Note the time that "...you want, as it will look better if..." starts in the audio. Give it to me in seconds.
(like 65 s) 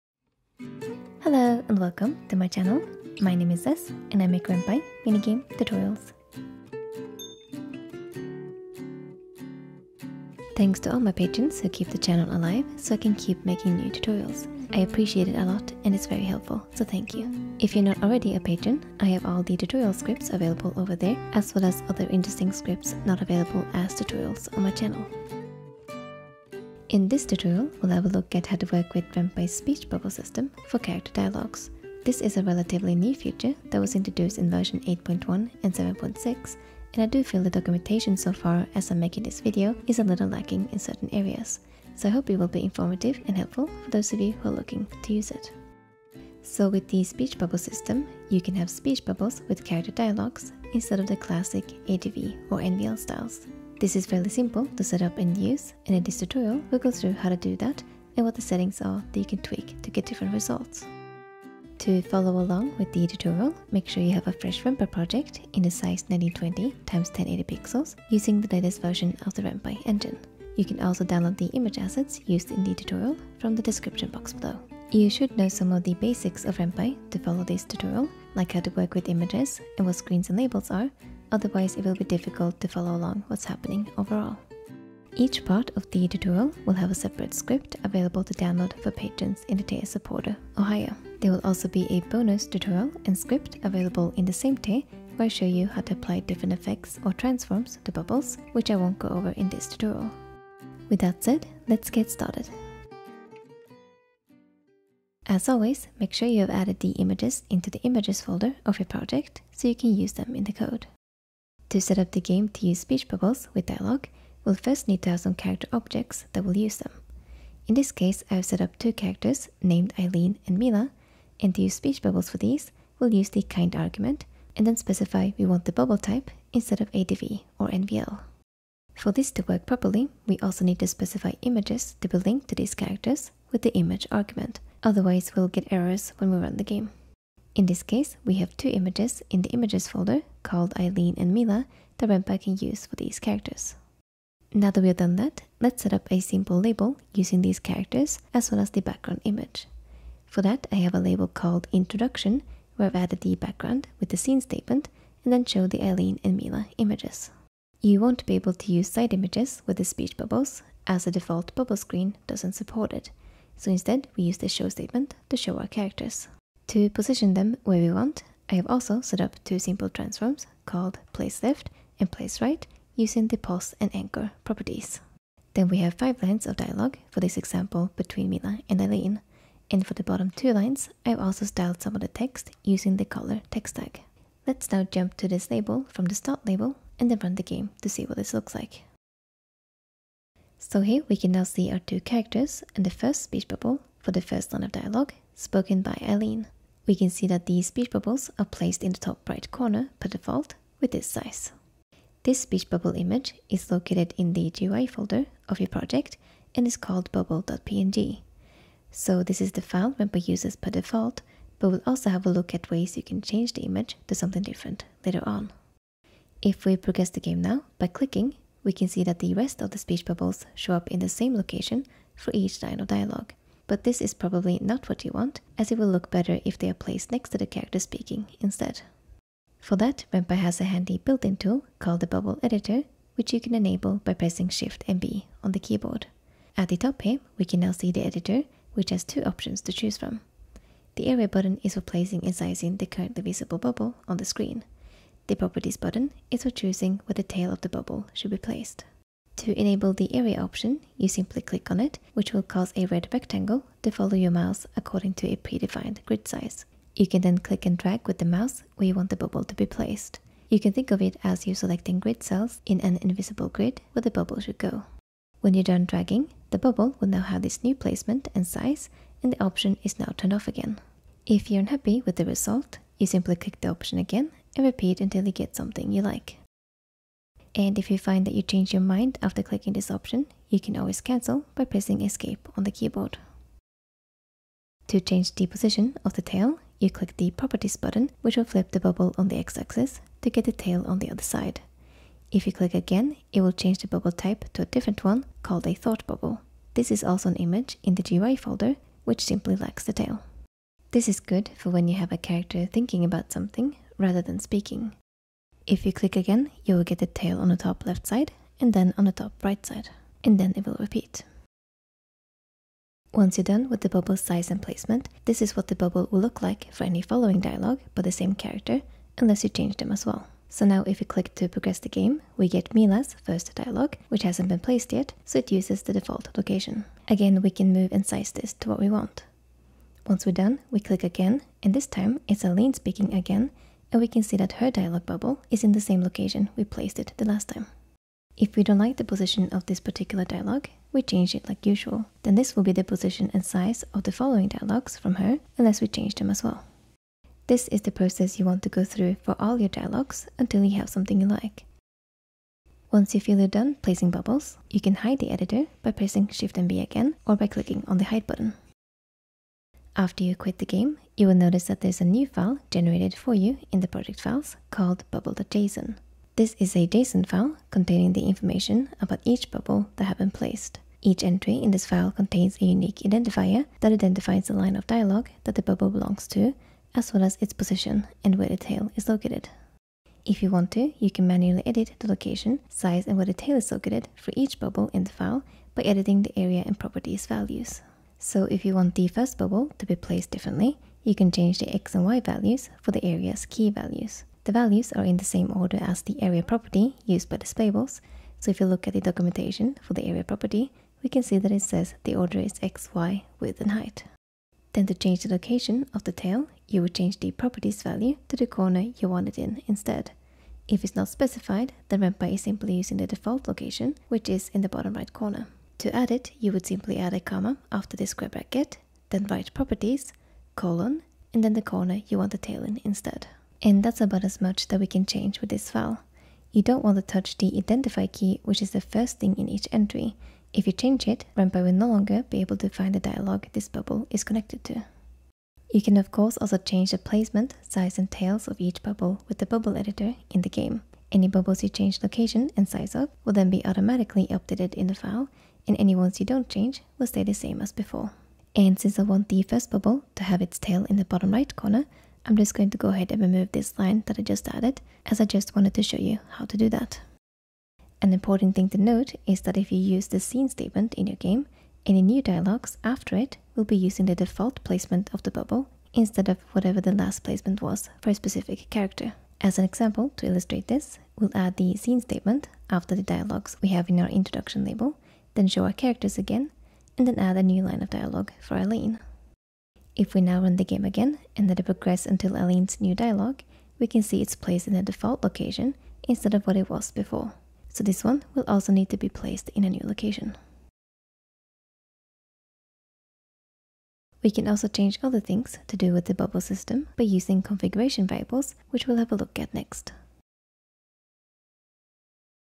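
225 s.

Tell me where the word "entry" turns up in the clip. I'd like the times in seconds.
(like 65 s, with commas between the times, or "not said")
371 s, 429 s.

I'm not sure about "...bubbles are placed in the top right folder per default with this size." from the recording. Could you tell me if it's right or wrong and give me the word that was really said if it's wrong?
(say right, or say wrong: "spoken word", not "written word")
wrong: "corner", not "folder".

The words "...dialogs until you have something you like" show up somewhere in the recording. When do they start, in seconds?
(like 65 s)
349 s.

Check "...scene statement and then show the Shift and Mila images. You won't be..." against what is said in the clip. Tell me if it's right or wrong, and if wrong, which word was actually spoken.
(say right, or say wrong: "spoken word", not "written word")
wrong: "Eileen", not "Shift".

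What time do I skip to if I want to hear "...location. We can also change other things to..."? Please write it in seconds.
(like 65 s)
489 s.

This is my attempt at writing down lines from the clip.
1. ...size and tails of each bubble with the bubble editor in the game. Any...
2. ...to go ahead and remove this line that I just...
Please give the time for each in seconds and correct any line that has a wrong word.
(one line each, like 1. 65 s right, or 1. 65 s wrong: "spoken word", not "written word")
1. 437 s right
2. 452 s right.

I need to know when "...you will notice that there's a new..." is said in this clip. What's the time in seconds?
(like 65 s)
361 s.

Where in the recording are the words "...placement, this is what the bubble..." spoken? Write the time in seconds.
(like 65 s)
314 s.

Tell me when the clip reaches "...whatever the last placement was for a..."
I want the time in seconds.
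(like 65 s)
466 s.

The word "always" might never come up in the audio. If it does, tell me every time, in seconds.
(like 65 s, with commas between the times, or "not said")
105 s, 280 s.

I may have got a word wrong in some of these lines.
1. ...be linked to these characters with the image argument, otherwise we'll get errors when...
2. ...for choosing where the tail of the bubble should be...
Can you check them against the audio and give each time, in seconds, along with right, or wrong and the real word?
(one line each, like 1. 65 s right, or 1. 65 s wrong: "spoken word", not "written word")
1. 132 s right
2. 246 s right.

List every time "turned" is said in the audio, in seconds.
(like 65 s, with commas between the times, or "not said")
270 s.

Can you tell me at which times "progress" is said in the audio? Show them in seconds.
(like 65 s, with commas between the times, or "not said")
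216 s, 321 s, 481 s.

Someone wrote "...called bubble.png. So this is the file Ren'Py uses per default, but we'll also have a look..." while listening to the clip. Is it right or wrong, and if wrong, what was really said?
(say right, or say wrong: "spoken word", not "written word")
right.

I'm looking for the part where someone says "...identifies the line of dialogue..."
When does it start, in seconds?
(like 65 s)
373 s.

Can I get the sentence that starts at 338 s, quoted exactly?
If we don't like the position of this particular dialog, we change it like usual.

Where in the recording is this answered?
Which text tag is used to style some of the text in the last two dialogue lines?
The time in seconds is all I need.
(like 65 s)
183 s.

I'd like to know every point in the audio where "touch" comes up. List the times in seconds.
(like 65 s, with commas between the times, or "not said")
427 s.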